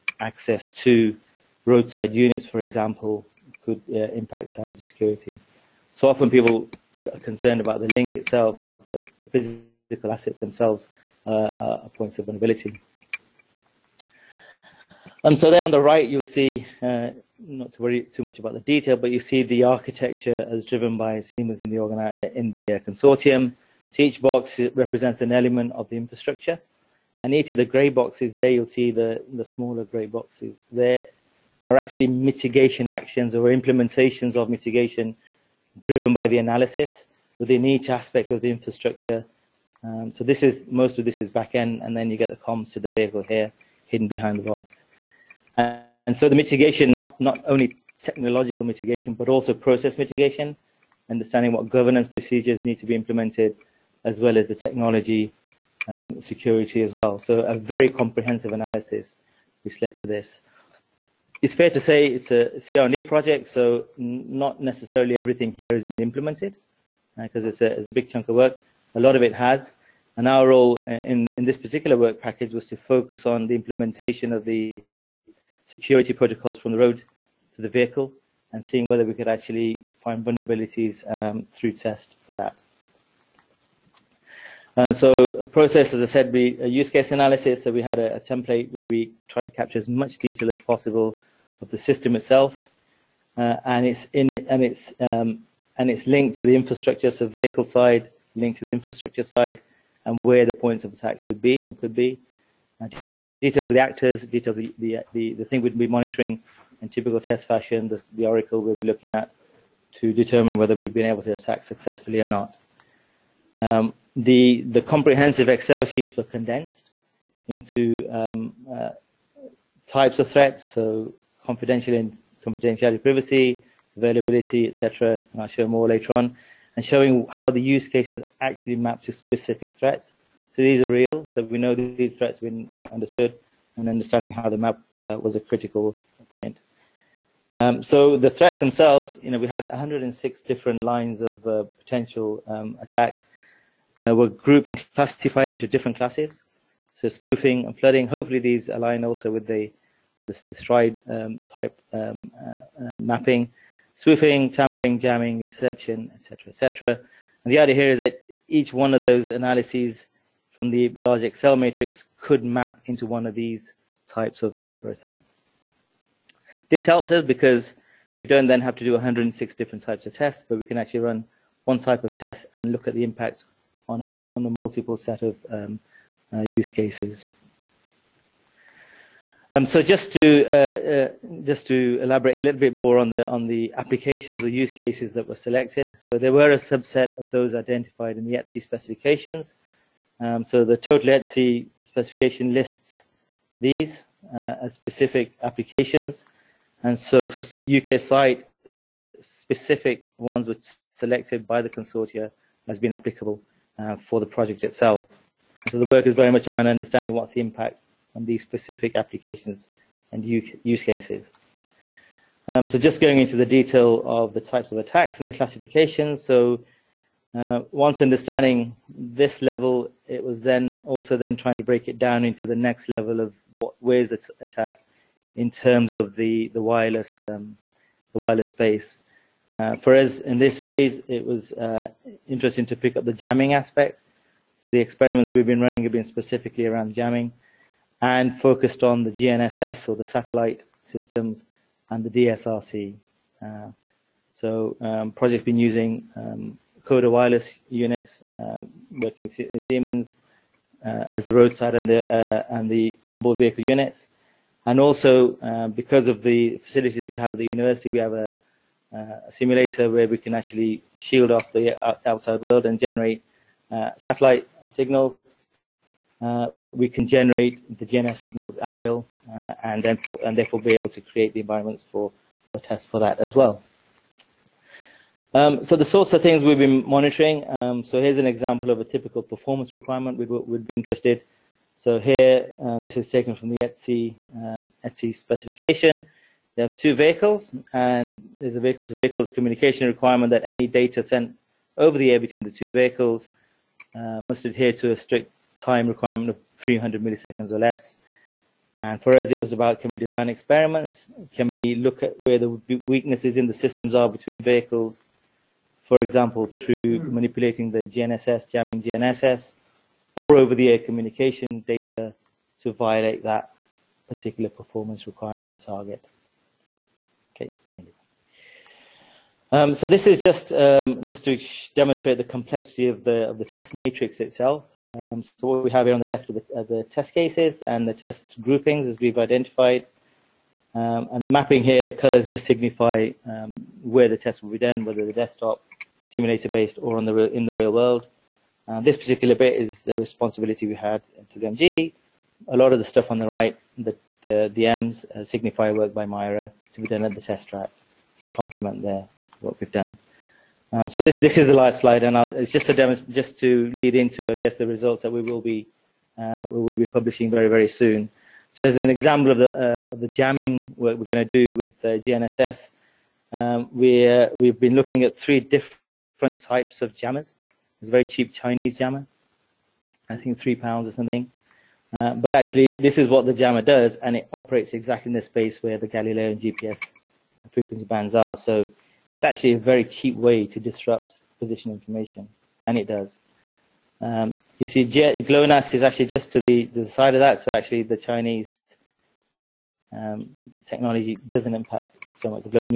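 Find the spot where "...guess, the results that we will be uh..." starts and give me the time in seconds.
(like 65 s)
354 s.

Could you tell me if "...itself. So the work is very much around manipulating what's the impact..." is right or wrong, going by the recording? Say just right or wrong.
wrong.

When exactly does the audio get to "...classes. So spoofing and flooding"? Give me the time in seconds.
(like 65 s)
145 s.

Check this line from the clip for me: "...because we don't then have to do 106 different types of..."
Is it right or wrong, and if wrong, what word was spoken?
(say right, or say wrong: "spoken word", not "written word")
right.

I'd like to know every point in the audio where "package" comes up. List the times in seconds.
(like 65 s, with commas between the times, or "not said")
72 s.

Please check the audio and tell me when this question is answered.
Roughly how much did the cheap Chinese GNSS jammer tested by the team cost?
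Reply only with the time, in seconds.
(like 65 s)
370 s.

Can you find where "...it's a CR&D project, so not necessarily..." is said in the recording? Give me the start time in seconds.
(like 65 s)
62 s.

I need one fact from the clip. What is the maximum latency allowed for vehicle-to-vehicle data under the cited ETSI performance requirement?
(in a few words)
300 milliseconds.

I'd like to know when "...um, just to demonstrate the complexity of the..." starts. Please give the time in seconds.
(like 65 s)
320 s.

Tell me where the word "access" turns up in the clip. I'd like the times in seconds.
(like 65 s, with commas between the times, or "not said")
0 s.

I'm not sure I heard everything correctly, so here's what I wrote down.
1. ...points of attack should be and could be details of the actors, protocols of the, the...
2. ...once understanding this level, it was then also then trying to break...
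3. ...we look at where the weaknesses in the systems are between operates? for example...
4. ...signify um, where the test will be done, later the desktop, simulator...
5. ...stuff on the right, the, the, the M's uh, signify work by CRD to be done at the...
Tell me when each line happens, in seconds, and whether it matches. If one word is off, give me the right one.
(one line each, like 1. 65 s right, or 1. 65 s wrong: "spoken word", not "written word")
1. 100 s wrong: "details", not "protocols"
2. 217 s right
3. 301 s wrong: "vehicles", not "operates"
4. 332 s wrong: "whether", not "later"
5. 342 s wrong: "MIRA", not "CRD".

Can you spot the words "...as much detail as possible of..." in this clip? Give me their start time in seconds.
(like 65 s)
89 s.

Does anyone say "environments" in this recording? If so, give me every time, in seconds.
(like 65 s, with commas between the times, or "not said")
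271 s.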